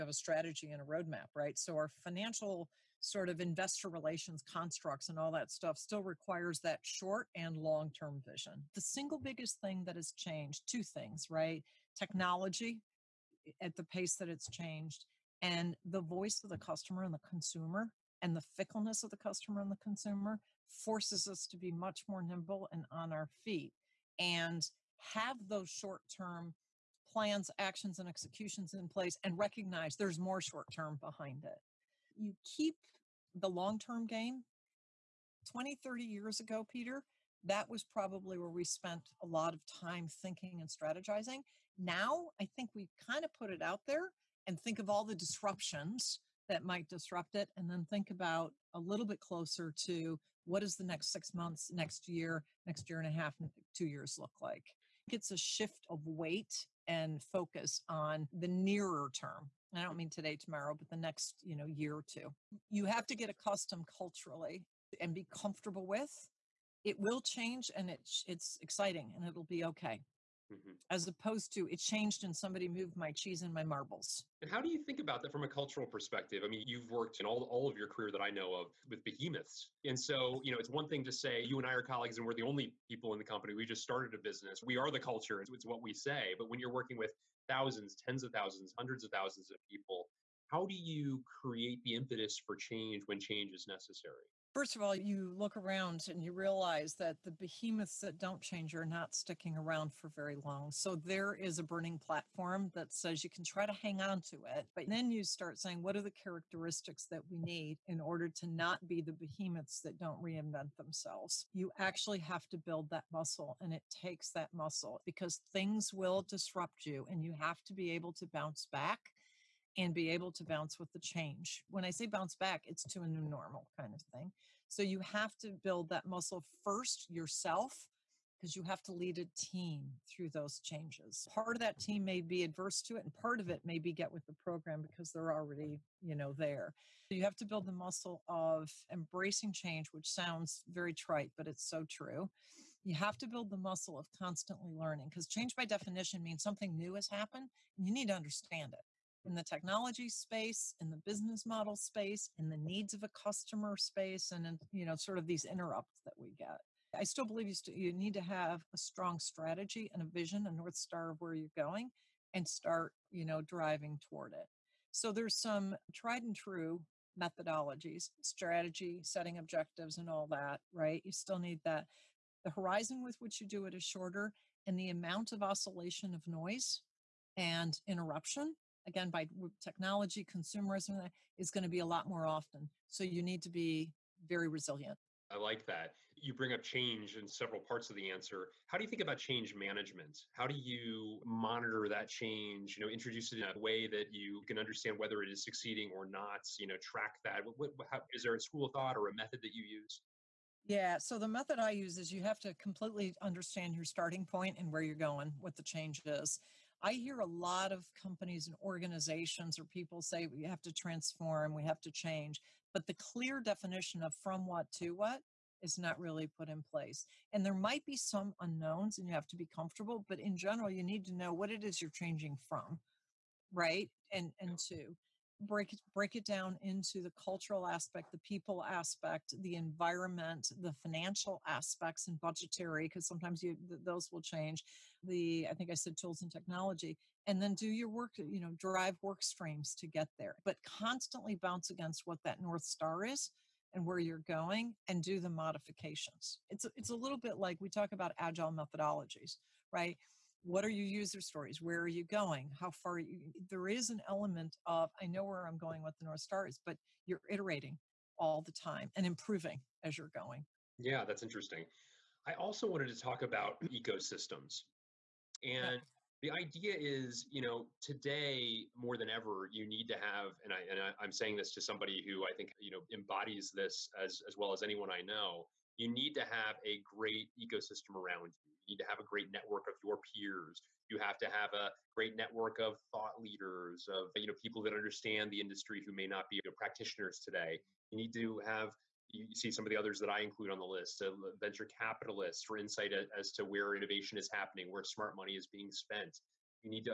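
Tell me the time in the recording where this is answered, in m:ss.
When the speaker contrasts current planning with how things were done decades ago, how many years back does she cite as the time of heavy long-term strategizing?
0:35.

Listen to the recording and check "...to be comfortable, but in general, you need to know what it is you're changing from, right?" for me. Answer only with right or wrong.
right.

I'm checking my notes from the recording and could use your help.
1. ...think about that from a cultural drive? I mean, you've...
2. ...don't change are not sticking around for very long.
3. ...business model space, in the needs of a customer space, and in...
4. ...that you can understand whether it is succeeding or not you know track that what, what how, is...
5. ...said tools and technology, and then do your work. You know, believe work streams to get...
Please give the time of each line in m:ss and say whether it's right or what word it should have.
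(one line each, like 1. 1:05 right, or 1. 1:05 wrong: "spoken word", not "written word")
1. 1:14 wrong: "perspective", not "drive"
2. 1:38 right
3. 2:30 right
4. 3:13 right
5. 3:55 wrong: "drive", not "believe".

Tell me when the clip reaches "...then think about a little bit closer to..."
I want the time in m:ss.
0:47.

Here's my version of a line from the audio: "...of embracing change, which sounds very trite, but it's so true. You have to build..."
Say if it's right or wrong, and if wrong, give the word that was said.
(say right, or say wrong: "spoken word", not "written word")
right.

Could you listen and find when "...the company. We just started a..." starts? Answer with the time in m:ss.
1:23.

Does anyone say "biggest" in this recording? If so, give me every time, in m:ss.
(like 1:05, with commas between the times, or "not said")
0:09.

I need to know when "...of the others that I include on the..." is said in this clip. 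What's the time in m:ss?
4:49.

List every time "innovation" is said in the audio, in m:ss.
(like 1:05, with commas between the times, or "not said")
4:53.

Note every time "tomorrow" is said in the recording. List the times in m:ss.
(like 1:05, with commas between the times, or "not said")
1:00.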